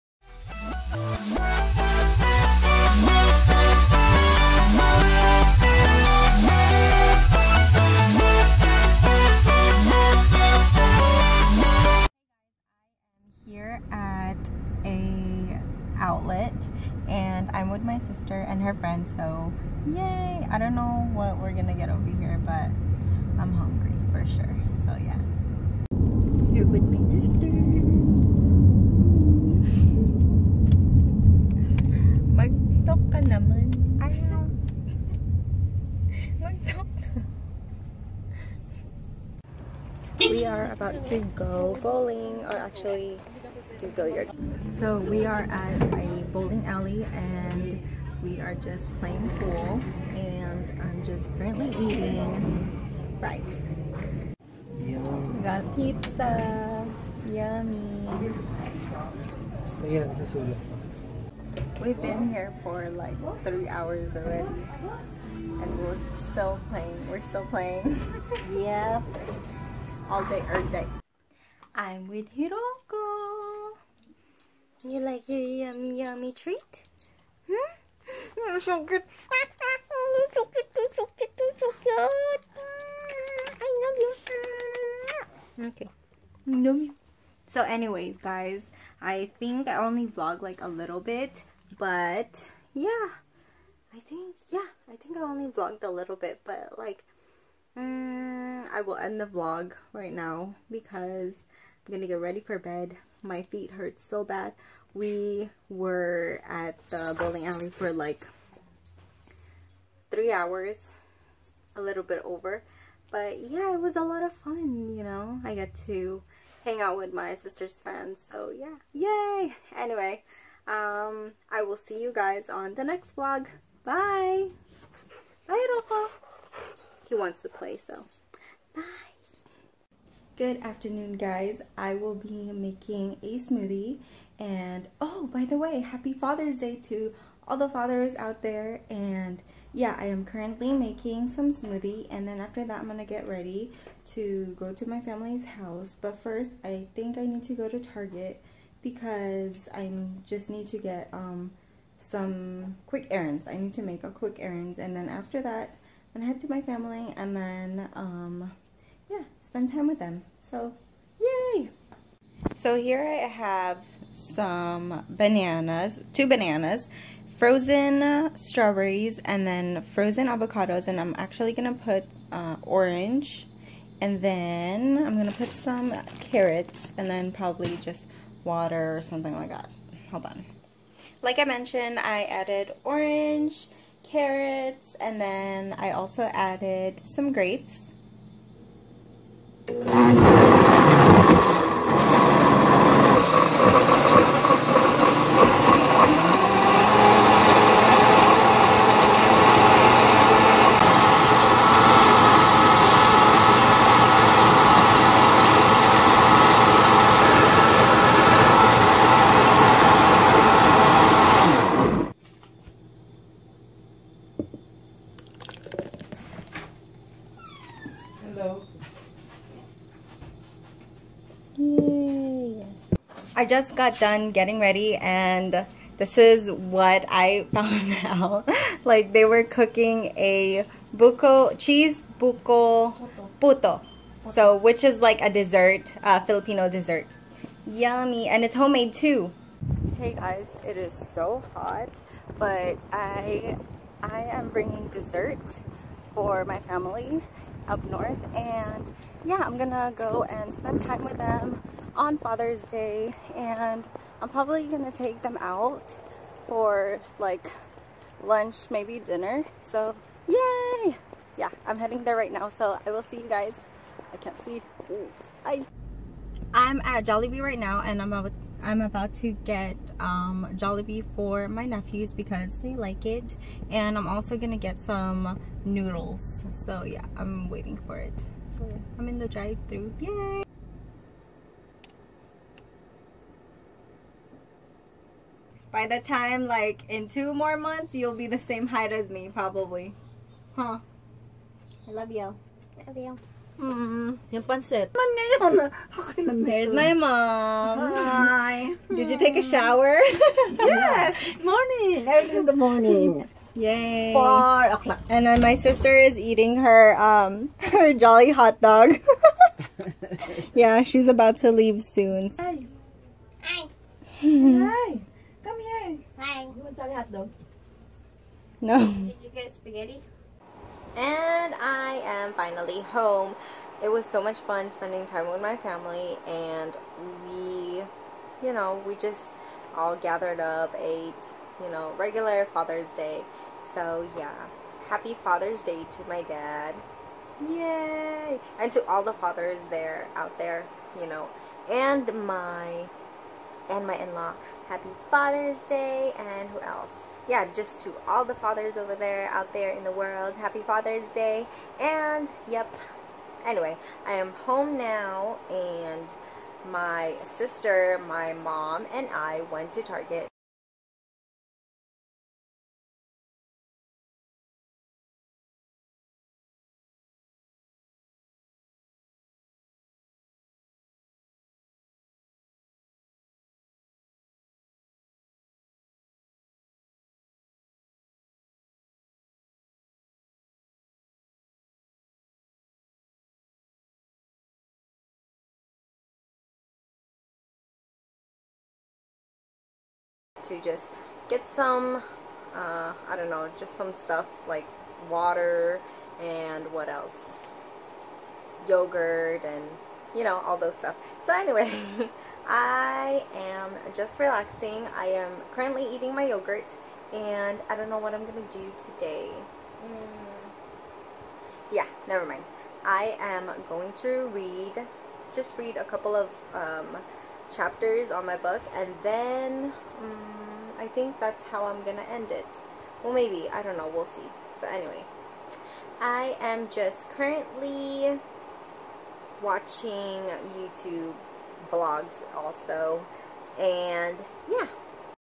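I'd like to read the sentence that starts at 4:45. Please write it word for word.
By the time like in two more months, you'll be the same height as me probably.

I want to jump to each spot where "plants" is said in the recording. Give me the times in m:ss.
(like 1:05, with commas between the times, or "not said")
not said.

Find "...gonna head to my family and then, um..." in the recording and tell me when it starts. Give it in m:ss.
2:36.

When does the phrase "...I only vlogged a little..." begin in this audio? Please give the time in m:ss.
1:35.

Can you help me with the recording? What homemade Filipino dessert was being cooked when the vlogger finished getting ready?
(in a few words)
Cheese buko puto.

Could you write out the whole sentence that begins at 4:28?
I'm about to get um, Jollibee for my nephews because they like it.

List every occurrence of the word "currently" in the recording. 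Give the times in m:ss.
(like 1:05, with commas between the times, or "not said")
0:51, 2:20, 6:45, 7:07.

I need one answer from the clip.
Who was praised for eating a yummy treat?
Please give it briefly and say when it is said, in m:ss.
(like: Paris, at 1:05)
Hiroko, at 1:12.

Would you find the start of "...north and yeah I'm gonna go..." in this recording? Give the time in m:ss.
4:07.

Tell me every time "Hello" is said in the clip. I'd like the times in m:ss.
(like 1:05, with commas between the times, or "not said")
3:38.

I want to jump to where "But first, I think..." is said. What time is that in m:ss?
2:25.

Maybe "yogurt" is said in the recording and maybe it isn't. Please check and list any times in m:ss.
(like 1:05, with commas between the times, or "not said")
6:38, 6:46.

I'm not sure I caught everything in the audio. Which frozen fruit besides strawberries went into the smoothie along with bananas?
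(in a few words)
Avocados.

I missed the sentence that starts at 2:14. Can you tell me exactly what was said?
And oh, by the way, happy Father's Day to all the fathers out there.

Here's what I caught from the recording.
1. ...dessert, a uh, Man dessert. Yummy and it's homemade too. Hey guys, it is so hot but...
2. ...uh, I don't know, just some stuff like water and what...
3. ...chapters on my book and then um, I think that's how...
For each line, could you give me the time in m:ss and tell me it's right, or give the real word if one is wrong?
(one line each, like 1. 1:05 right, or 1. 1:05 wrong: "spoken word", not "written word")
1. 3:55 wrong: "Filipino", not "Man"
2. 6:32 right
3. 6:57 right.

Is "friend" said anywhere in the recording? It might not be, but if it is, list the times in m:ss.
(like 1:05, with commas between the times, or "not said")
0:18, 1:57.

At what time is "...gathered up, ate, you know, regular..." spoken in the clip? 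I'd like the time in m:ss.
5:29.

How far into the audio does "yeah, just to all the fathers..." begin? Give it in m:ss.
5:47.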